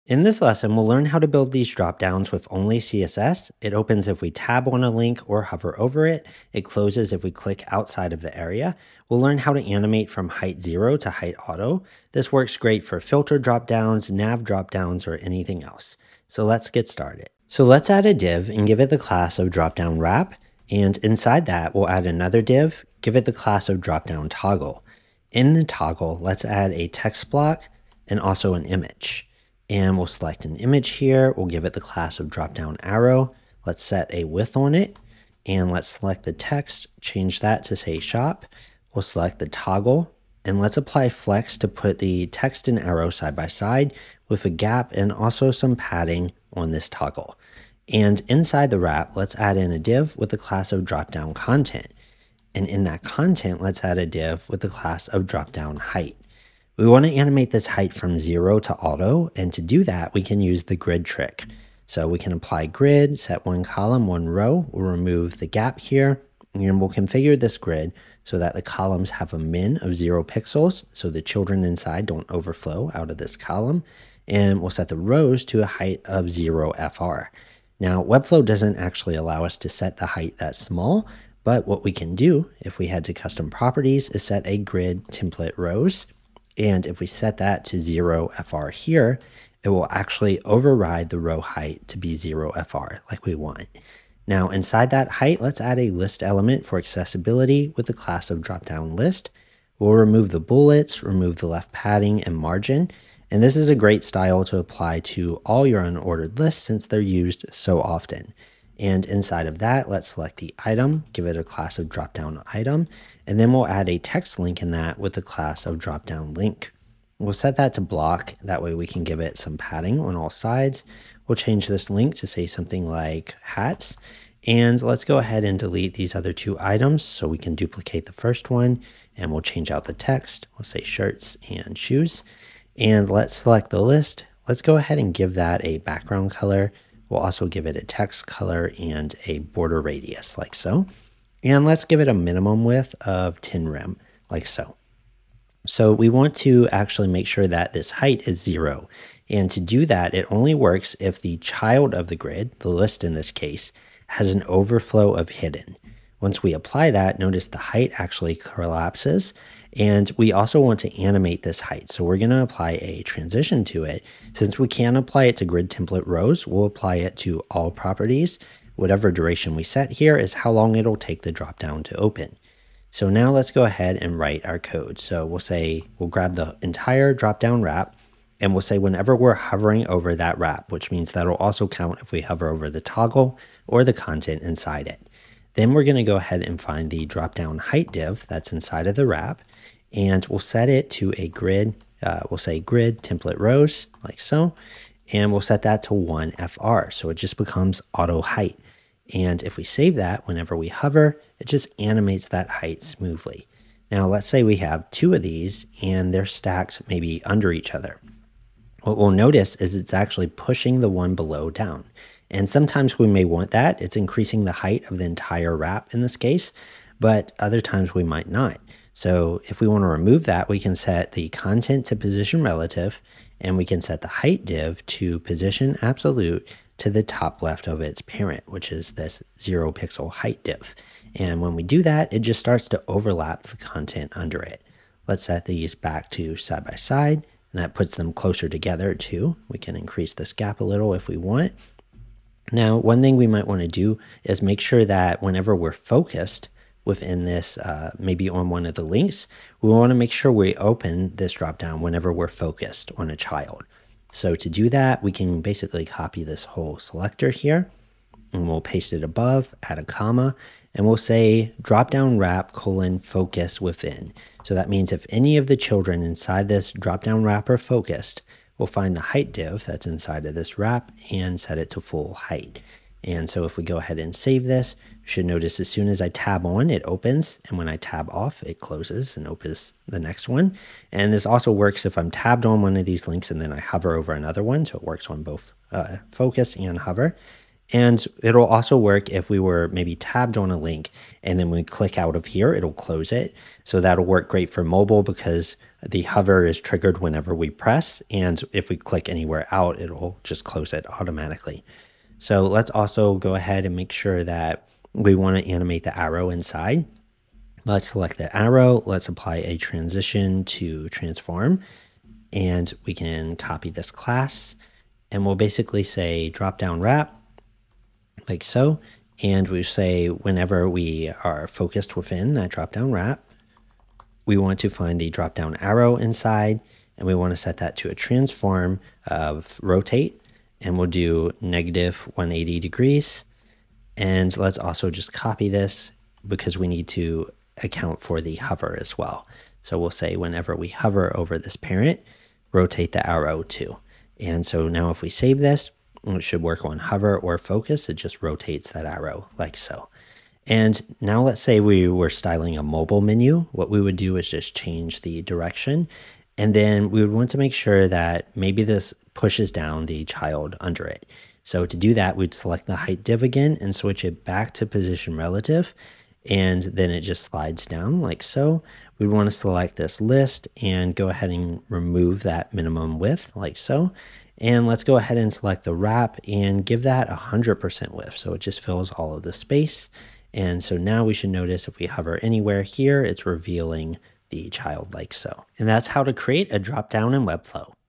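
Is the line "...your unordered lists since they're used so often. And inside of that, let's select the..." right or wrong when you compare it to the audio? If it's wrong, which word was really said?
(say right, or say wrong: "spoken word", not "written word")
right.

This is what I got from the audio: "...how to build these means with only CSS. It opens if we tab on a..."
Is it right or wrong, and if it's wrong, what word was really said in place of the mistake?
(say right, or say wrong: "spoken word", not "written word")
wrong: "dropdowns", not "means".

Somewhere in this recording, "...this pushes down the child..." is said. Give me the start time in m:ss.
5:58.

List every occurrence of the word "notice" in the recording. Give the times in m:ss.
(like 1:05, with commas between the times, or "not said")
2:37, 3:29, 4:35, 6:21.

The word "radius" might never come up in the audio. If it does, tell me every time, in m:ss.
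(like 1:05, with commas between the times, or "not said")
2:19.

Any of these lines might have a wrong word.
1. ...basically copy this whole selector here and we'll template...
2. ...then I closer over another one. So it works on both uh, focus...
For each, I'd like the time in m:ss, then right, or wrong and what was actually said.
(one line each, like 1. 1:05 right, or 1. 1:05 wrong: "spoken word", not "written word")
1. 4:15 wrong: "paste", not "template"
2. 4:43 wrong: "hover", not "closer".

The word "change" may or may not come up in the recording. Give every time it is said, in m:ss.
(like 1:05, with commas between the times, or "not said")
0:36, 2:01, 2:09, 5:54.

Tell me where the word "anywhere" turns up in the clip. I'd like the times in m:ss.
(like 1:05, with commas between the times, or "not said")
4:59, 6:22.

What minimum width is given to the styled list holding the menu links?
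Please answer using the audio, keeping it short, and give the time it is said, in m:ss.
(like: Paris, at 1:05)
10 rem, at 2:23.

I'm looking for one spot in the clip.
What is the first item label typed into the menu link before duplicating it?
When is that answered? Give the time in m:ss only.
2:03.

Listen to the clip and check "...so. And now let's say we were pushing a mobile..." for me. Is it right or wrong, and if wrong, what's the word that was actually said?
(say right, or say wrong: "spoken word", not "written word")
wrong: "styling", not "pushing".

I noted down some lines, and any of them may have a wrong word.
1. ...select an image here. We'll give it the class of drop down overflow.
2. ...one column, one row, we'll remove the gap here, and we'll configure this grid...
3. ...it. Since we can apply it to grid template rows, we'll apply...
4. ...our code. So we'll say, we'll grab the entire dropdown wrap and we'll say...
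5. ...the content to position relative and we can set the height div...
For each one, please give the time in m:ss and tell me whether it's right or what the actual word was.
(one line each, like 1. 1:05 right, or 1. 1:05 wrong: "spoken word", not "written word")
1. 0:30 wrong: "arrow", not "overflow"
2. 1:03 right
3. 2:43 right
4. 2:54 right
5. 3:41 right.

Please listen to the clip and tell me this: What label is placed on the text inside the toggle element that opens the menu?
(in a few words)
Shop.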